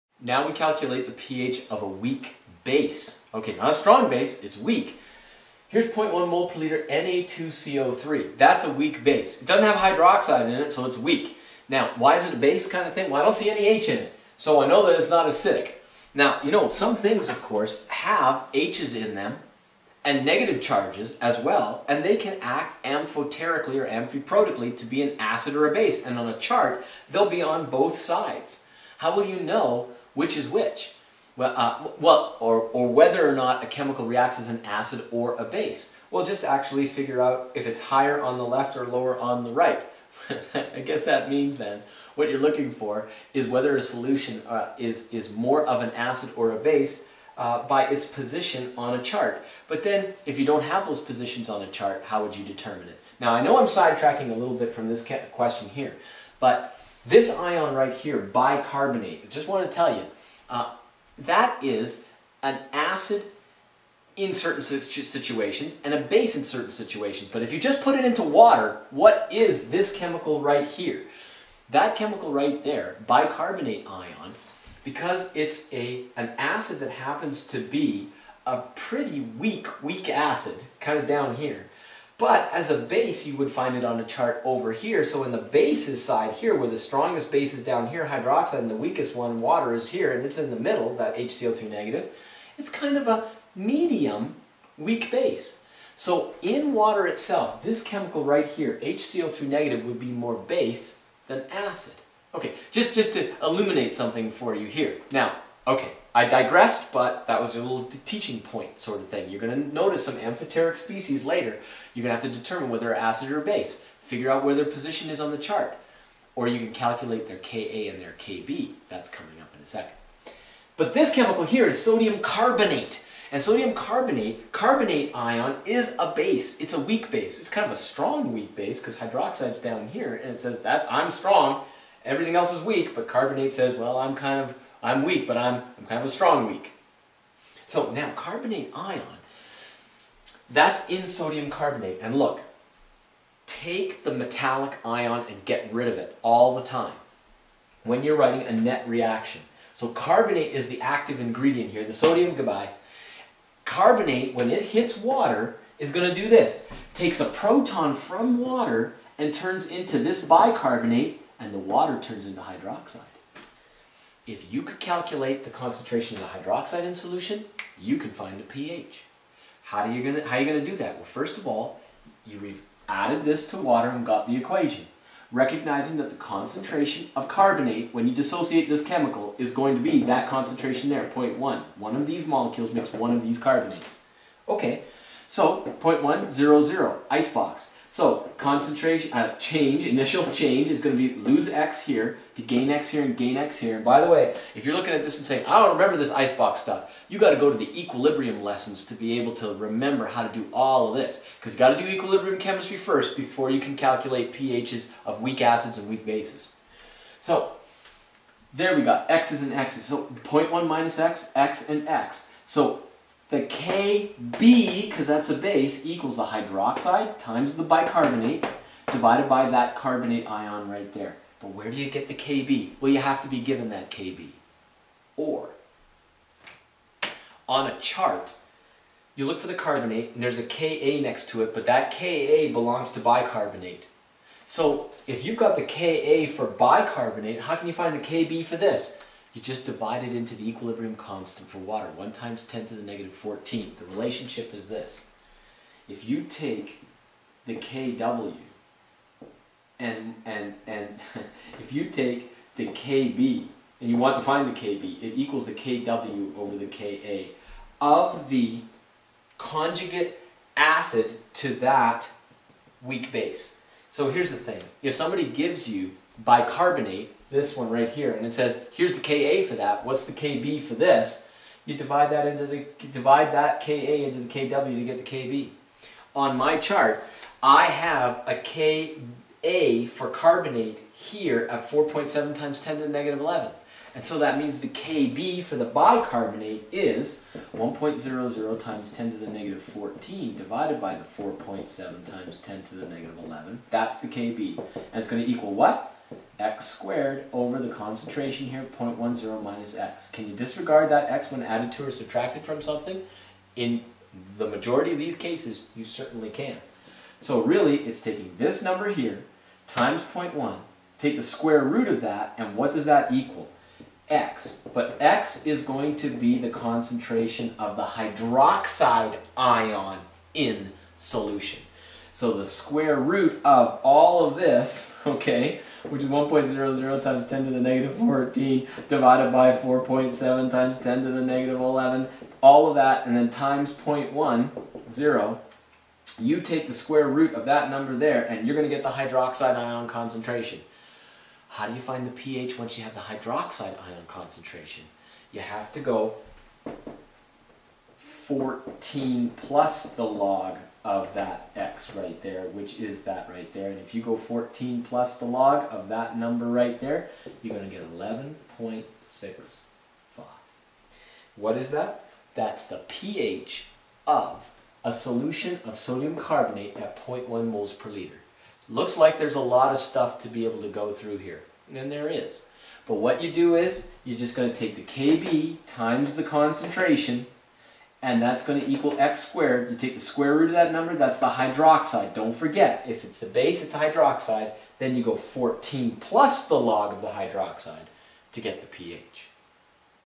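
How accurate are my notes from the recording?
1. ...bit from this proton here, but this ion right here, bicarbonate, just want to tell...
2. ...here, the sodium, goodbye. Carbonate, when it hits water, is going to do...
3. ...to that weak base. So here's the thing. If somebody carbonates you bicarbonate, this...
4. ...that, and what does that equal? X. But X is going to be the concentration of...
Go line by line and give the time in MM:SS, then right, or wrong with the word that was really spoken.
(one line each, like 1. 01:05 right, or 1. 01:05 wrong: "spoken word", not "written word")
1. 00:54 wrong: "question", not "proton"
2. 02:31 right
3. 04:21 wrong: "gives", not "carbonates"
4. 05:12 right.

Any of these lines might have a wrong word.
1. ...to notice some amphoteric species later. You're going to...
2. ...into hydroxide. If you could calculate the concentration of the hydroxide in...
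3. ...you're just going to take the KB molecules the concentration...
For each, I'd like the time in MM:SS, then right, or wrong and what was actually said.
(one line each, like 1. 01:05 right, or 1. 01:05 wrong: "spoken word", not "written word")
1. 01:49 right
2. 02:42 right
3. 06:14 wrong: "times", not "molecules".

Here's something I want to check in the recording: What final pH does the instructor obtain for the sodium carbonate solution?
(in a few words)
11.65.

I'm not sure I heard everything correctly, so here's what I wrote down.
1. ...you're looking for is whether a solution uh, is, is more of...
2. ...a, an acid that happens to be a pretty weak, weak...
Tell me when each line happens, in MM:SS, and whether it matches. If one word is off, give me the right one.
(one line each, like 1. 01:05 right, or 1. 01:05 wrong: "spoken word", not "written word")
1. 00:42 right
2. 01:15 right.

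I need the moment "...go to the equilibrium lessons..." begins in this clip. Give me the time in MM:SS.
03:17.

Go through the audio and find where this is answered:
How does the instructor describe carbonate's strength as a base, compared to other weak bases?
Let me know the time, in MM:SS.
02:07.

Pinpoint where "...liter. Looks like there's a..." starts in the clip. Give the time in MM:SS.
06:07.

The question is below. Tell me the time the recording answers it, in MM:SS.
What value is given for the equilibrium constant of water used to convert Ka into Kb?
04:01.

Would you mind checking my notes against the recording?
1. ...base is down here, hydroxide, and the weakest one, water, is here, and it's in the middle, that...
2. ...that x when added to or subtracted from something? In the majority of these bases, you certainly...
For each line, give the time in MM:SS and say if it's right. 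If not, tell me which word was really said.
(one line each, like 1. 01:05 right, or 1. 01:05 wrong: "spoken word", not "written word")
1. 01:27 right
2. 05:00 wrong: "cases", not "bases".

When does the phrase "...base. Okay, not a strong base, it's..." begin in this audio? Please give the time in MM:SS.
00:02.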